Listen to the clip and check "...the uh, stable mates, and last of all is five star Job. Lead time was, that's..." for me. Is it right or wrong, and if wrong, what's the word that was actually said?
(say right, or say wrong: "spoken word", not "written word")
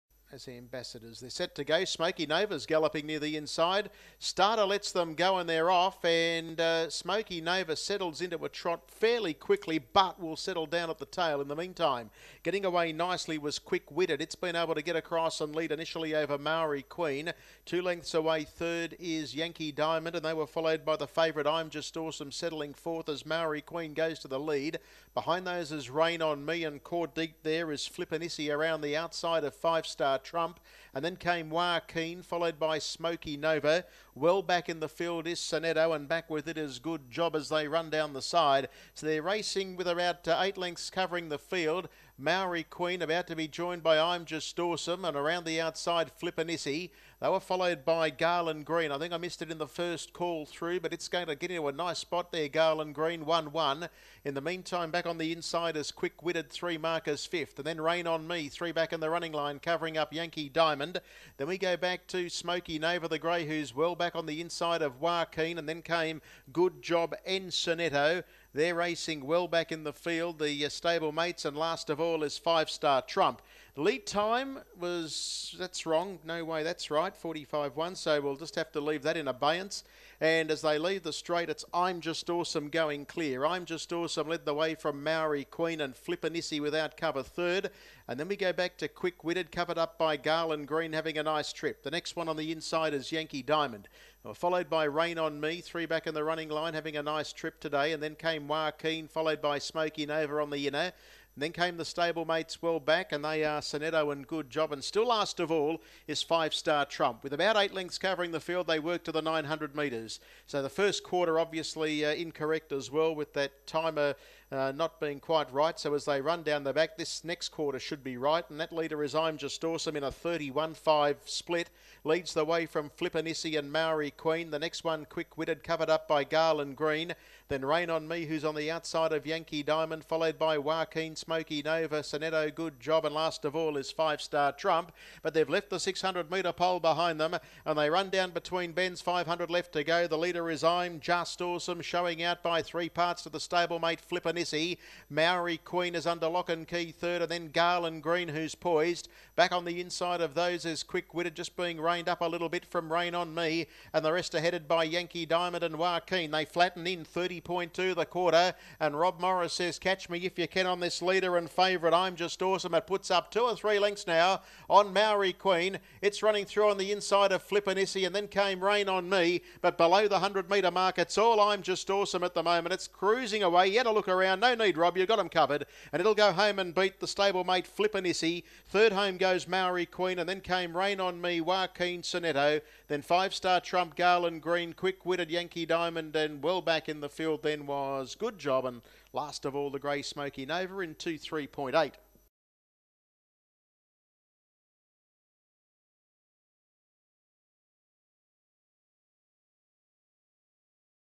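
wrong: "Trump", not "Job".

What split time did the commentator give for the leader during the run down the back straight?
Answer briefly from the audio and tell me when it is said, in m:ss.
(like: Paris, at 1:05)
31.5, at 2:00.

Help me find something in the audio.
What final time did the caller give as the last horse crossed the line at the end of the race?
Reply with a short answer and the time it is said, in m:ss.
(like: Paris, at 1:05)
2:03.8, at 3:10.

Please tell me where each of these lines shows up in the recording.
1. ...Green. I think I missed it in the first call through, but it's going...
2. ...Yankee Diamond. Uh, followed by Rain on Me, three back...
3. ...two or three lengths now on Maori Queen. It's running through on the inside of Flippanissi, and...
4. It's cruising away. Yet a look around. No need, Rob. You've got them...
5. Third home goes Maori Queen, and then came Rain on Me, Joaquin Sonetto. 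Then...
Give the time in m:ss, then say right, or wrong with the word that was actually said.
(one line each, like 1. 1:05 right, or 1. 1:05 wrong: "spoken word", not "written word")
1. 0:48 right
2. 1:33 right
3. 2:43 right
4. 2:52 right
5. 2:58 right.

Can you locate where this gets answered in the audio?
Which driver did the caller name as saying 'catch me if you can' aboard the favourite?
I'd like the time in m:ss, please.
2:38.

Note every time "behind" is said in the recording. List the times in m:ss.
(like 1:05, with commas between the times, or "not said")
0:25, 2:16.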